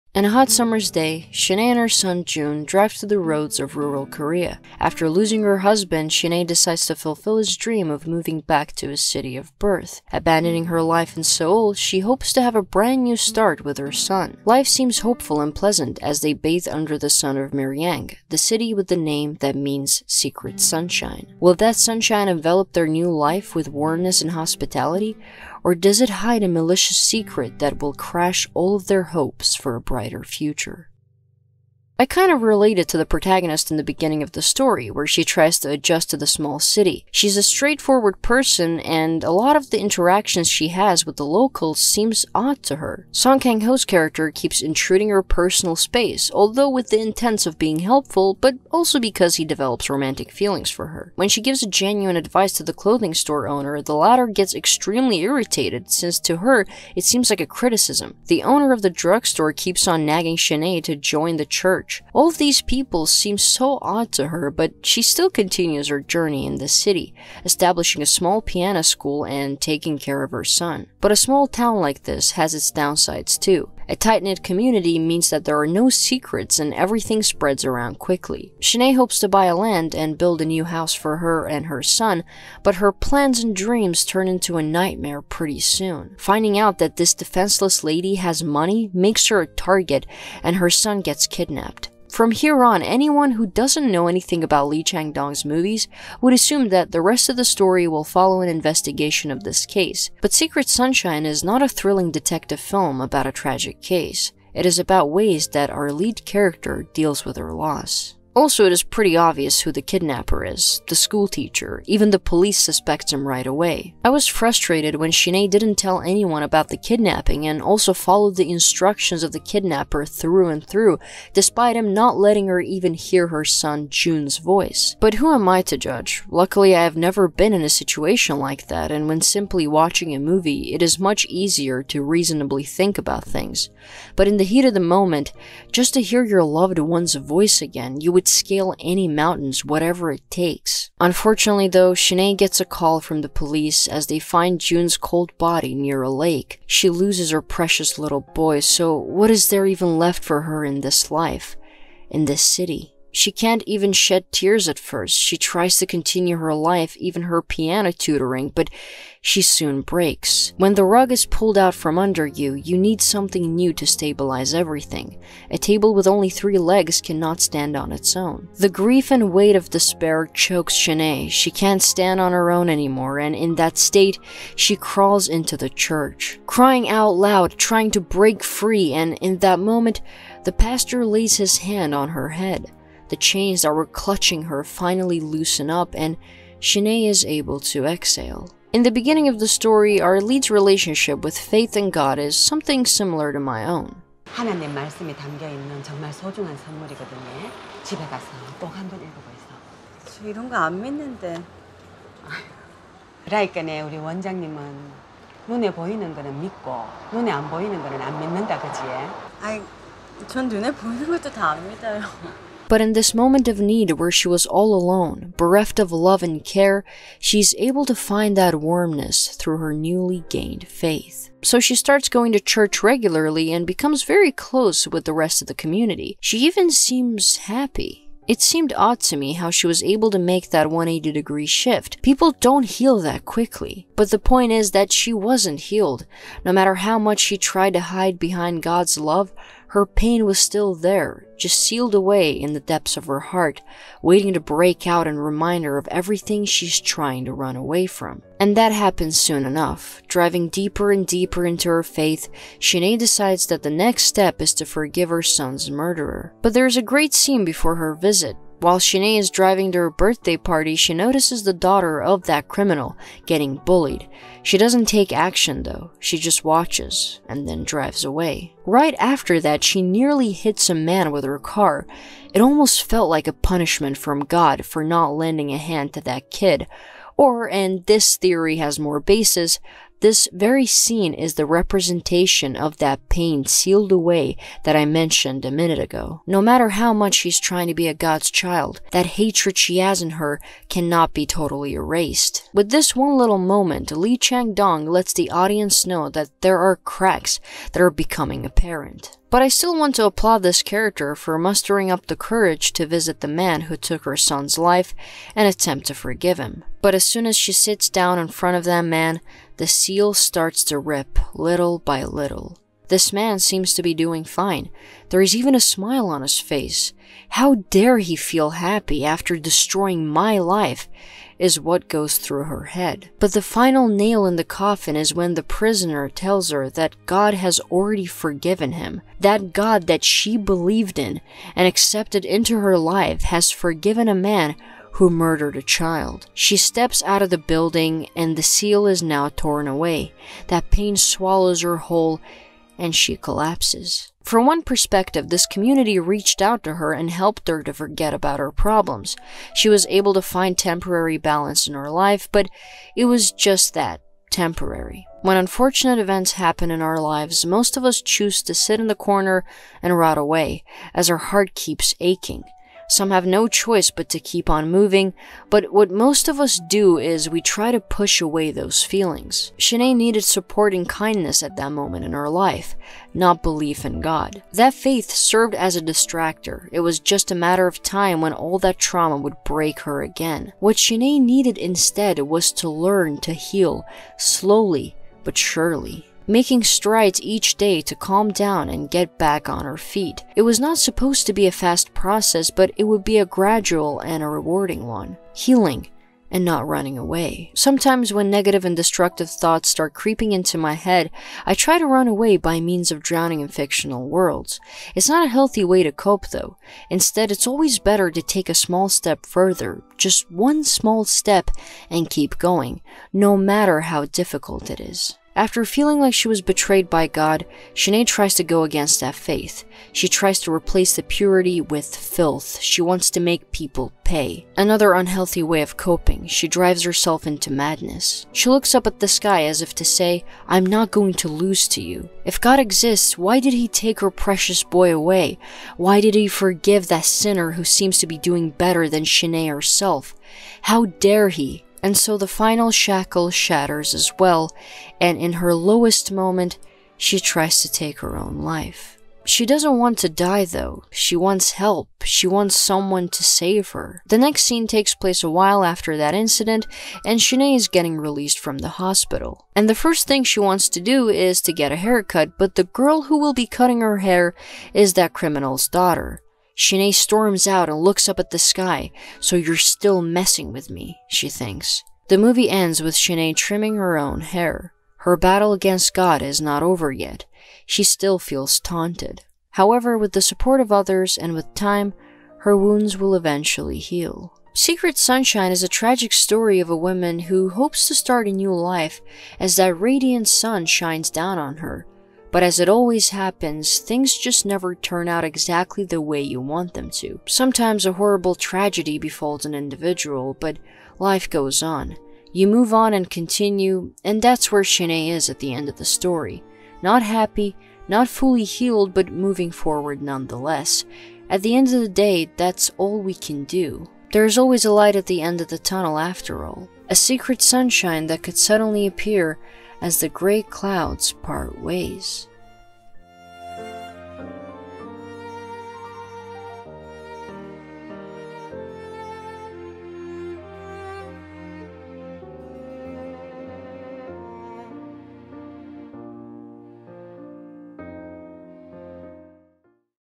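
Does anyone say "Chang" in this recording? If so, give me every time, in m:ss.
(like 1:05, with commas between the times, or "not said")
1:34, 4:54.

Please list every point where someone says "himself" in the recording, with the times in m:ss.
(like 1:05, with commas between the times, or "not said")
not said.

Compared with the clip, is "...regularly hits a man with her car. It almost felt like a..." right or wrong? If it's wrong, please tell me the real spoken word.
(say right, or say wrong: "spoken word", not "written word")
wrong: "nearly", not "regularly".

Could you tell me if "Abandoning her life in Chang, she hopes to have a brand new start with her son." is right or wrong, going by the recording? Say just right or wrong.
wrong.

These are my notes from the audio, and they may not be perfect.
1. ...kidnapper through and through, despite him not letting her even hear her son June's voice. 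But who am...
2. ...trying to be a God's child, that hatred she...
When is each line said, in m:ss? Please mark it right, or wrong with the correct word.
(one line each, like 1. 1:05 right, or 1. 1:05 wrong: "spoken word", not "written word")
1. 1:59 right
2. 4:47 right.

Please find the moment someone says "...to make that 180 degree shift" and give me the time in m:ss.
3:50.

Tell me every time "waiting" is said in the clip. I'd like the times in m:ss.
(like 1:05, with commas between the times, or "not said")
4:04.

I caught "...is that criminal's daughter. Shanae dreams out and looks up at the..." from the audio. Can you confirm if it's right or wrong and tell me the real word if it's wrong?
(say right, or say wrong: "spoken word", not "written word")
wrong: "storms", not "dreams".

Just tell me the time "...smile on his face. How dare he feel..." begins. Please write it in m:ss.
5:15.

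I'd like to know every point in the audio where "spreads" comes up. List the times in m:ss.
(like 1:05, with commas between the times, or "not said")
1:17.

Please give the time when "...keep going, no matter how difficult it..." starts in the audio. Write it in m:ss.
6:52.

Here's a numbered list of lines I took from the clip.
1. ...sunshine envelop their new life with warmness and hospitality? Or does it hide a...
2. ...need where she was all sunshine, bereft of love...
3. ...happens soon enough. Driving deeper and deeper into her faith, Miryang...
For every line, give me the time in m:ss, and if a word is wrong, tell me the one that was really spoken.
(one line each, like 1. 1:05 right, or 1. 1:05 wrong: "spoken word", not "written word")
1. 0:21 right
2. 3:33 wrong: "alone", not "sunshine"
3. 4:08 wrong: "Shinee", not "Miryang".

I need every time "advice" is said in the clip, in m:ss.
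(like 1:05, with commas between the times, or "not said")
0:52.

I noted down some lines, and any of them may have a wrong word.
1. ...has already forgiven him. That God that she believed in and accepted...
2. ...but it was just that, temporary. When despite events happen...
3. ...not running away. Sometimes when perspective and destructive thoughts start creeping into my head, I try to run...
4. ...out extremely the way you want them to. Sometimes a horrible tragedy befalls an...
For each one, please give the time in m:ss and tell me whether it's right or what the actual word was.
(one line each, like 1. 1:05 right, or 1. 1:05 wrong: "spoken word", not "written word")
1. 5:27 right
2. 5:52 wrong: "unfortunate", not "despite"
3. 6:36 wrong: "negative", not "perspective"
4. 8:15 wrong: "exactly", not "extremely".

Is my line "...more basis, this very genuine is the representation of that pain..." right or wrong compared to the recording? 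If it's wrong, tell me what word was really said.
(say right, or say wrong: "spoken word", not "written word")
wrong: "scene", not "genuine".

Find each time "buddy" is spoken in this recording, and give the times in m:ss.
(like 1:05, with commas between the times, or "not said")
not said.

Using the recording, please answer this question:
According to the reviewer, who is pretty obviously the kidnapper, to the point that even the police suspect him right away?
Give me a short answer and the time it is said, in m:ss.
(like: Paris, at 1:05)
the schoolteacher, at 1:50.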